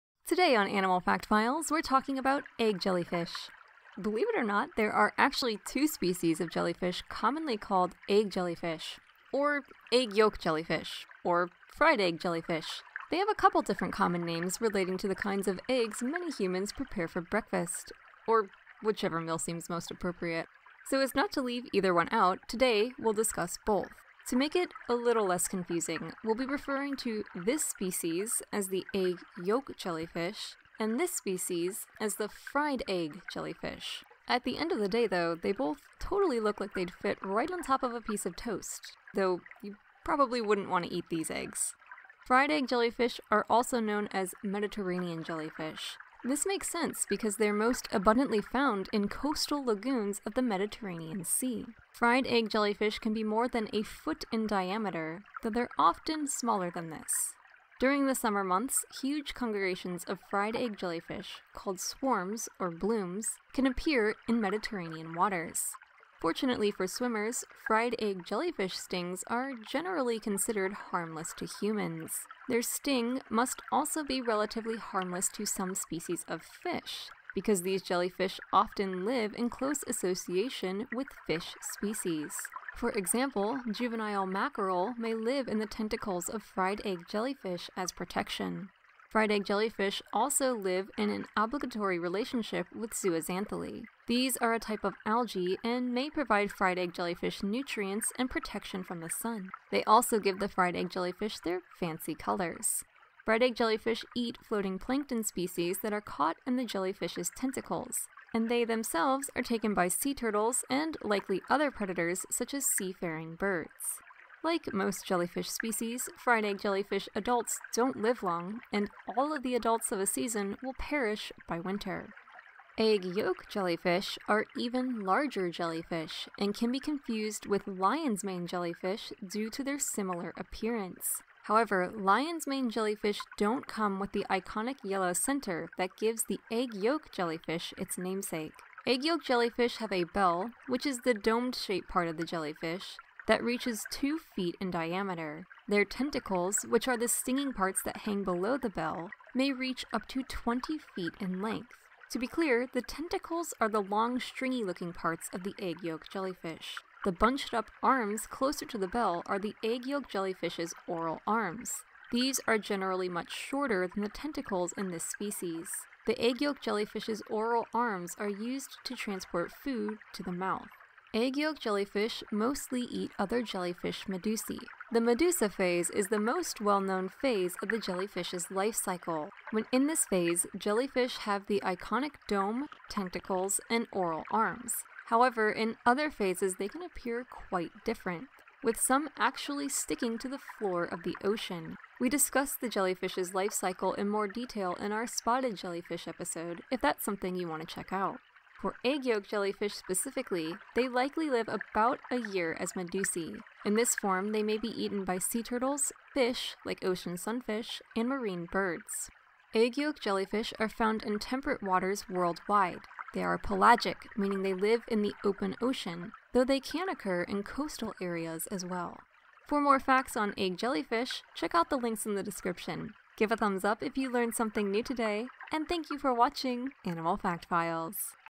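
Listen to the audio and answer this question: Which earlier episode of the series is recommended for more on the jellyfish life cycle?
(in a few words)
spotted jellyfish.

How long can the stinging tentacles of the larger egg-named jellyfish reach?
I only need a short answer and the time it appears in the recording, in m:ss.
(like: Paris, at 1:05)
20 feet, at 2:30.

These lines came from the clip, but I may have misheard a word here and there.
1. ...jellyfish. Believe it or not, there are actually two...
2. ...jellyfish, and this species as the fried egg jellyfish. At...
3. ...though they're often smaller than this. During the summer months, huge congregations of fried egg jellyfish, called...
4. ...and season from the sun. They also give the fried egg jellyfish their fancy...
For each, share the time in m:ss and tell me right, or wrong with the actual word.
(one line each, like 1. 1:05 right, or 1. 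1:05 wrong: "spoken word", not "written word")
1. 0:02 right
2. 0:29 right
3. 0:55 right
4. 1:38 wrong: "protection", not "season".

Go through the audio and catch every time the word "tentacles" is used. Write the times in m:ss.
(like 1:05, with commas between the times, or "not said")
1:25, 1:47, 2:25, 2:32, 2:44, 3:02.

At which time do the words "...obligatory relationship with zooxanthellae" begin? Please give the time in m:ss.
1:31.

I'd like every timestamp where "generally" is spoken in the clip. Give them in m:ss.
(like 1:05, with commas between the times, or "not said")
1:09, 2:42.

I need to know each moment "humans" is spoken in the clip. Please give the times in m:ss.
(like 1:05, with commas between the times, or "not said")
0:16, 1:11.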